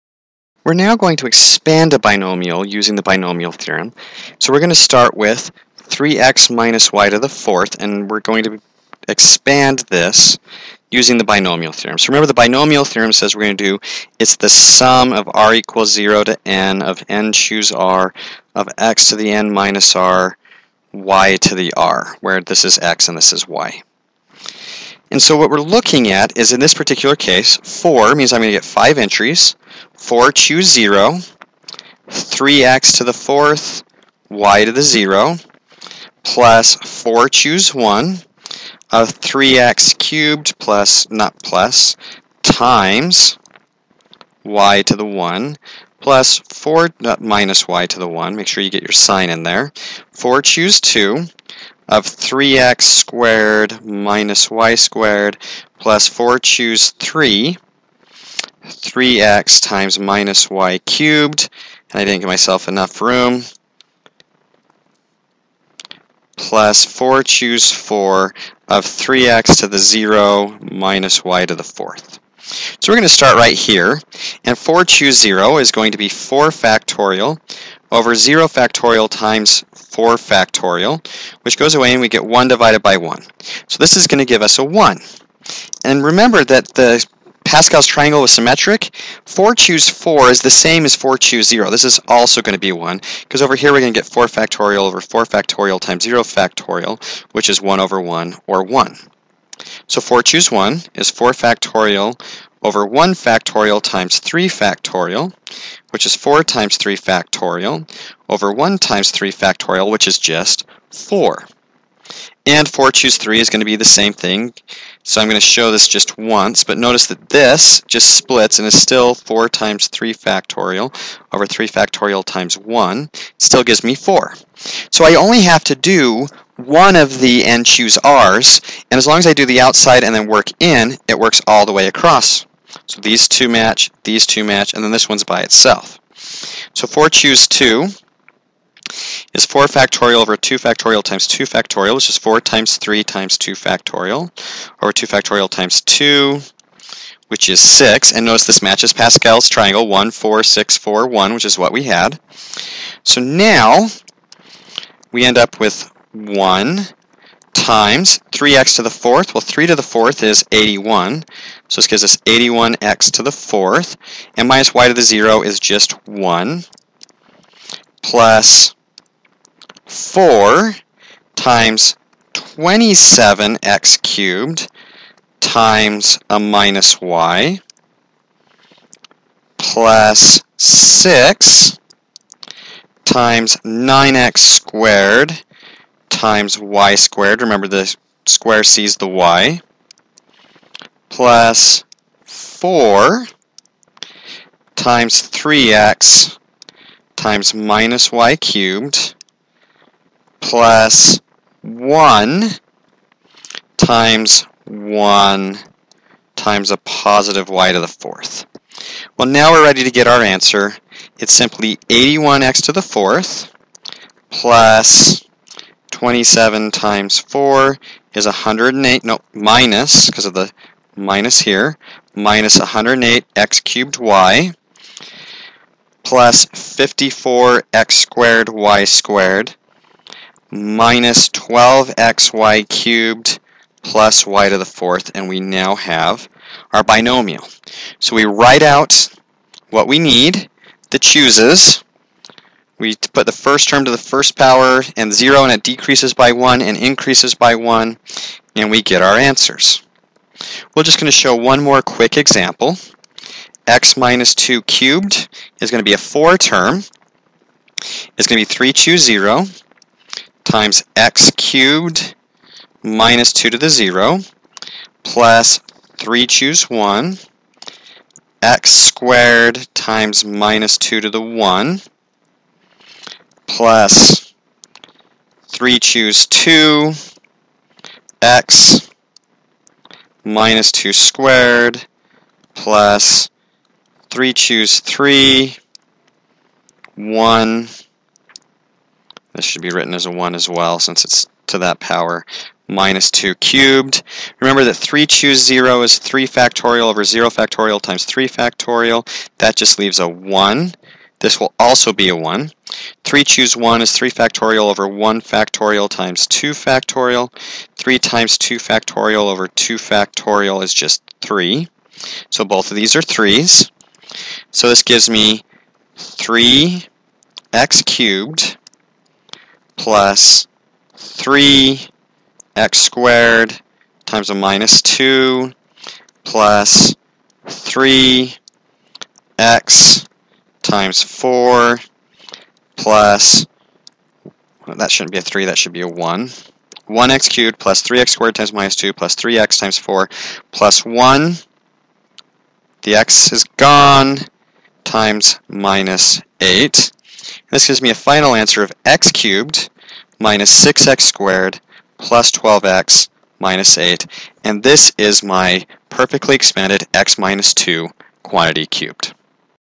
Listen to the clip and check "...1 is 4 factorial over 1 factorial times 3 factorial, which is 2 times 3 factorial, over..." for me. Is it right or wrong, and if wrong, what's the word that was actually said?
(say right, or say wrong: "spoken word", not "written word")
wrong: "4", not "2".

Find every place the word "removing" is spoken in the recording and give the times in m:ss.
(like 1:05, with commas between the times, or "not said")
not said.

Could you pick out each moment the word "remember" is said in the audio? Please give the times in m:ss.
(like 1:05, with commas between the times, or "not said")
0:12, 1:26, 3:07, 4:54.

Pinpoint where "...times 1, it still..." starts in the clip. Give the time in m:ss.
2:02.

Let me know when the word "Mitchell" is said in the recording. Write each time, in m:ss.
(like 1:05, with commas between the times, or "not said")
not said.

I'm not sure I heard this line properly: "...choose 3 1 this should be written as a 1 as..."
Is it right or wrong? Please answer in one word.
right.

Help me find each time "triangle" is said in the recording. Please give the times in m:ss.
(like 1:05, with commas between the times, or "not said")
1:27, 2:29.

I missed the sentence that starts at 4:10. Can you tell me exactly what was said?
We're just going to show one more quick example.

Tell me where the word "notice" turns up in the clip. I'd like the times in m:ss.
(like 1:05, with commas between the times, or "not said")
1:56, 2:28.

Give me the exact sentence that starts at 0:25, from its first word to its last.
And so what we're looking at is in this particular case, 4 means I'm going to get 5 entries.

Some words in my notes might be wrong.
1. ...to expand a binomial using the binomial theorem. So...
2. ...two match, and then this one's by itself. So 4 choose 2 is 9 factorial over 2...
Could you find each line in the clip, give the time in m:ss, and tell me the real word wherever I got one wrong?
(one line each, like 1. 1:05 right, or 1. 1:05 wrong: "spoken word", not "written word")
1. 0:01 right
2. 2:14 wrong: "4", not "9".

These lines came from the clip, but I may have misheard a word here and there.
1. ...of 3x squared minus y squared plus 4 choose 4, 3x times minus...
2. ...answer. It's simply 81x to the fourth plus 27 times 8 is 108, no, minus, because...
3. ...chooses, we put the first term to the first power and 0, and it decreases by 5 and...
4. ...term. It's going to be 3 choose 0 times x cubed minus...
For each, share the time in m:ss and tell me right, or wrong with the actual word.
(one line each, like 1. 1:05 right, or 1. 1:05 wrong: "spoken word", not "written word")
1. 0:51 wrong: "3", not "4"
2. 3:30 wrong: "4", not "8"
3. 4:00 wrong: "1", not "5"
4. 4:16 right.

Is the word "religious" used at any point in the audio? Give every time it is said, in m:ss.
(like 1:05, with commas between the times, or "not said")
not said.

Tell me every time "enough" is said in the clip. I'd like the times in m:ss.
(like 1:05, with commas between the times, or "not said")
1:02.